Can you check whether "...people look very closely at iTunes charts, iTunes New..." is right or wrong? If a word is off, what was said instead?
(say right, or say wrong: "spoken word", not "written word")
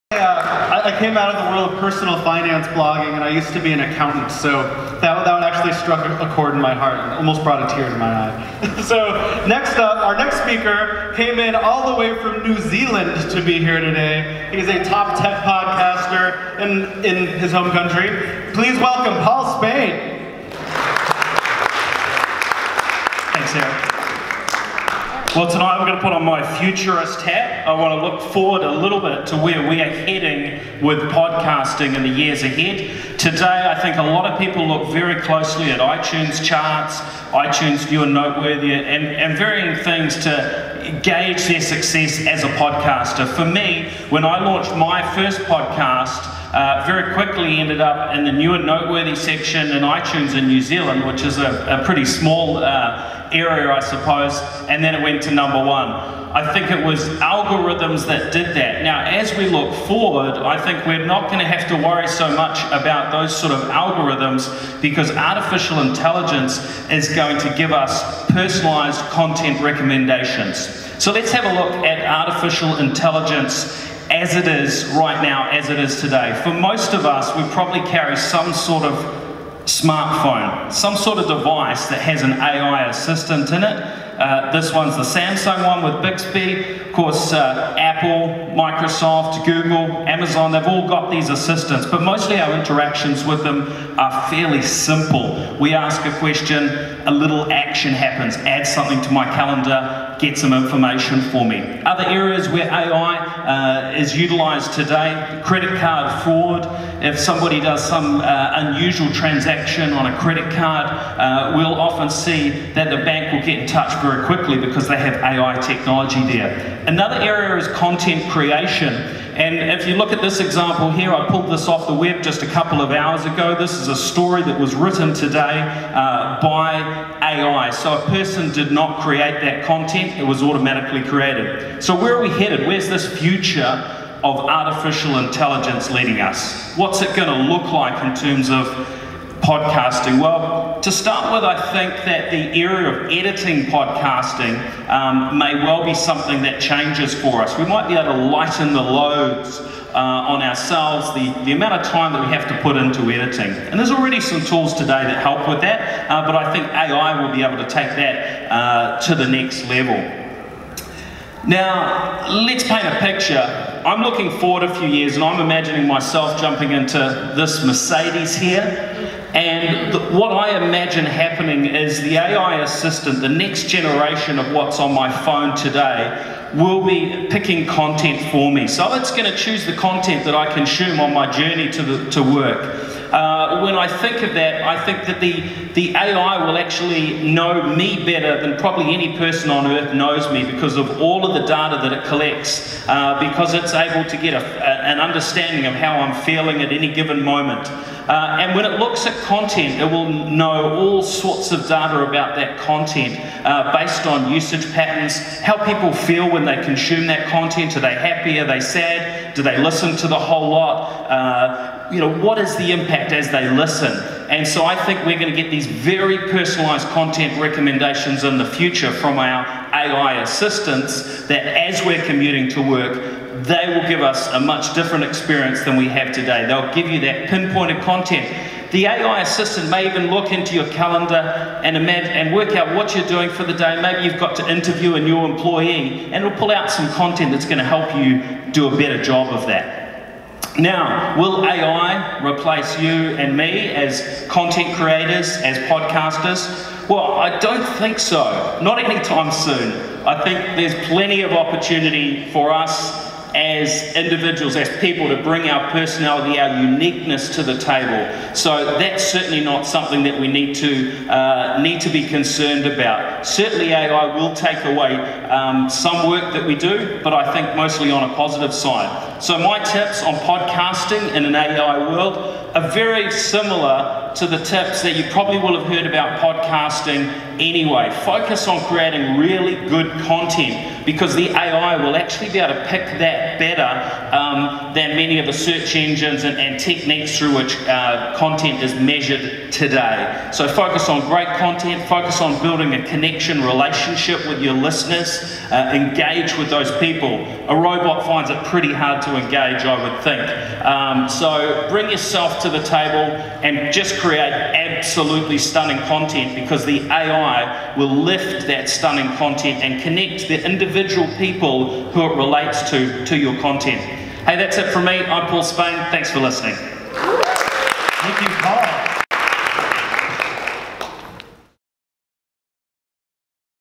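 right.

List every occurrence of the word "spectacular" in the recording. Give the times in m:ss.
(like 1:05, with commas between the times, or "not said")
not said.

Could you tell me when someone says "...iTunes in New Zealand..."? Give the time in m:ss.
0:49.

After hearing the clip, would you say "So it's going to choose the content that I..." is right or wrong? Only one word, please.
right.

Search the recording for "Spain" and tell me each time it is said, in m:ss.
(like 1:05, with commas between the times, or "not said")
0:19, 5:15.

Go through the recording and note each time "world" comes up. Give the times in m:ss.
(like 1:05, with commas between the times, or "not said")
0:01, 4:31.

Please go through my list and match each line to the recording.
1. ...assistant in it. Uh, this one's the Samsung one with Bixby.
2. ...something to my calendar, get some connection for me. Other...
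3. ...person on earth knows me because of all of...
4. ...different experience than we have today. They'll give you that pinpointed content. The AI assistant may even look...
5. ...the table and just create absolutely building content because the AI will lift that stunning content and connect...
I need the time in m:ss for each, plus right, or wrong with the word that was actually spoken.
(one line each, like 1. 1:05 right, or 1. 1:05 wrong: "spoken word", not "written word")
1. 1:22 right
2. 1:38 wrong: "information", not "connection"
3. 3:09 right
4. 3:44 right
5. 5:02 wrong: "stunning", not "building".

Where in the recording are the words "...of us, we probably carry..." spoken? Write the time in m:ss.
1:16.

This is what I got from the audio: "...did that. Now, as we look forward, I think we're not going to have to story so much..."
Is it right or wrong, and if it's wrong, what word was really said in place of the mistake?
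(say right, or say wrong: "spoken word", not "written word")
wrong: "worry", not "story".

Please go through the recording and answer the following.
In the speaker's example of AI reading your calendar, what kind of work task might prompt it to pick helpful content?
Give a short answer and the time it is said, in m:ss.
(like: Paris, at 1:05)
Interview a new employee, at 3:54.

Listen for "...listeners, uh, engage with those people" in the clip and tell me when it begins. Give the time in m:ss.
4:54.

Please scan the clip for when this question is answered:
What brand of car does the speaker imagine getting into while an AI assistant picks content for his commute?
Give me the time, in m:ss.
2:47.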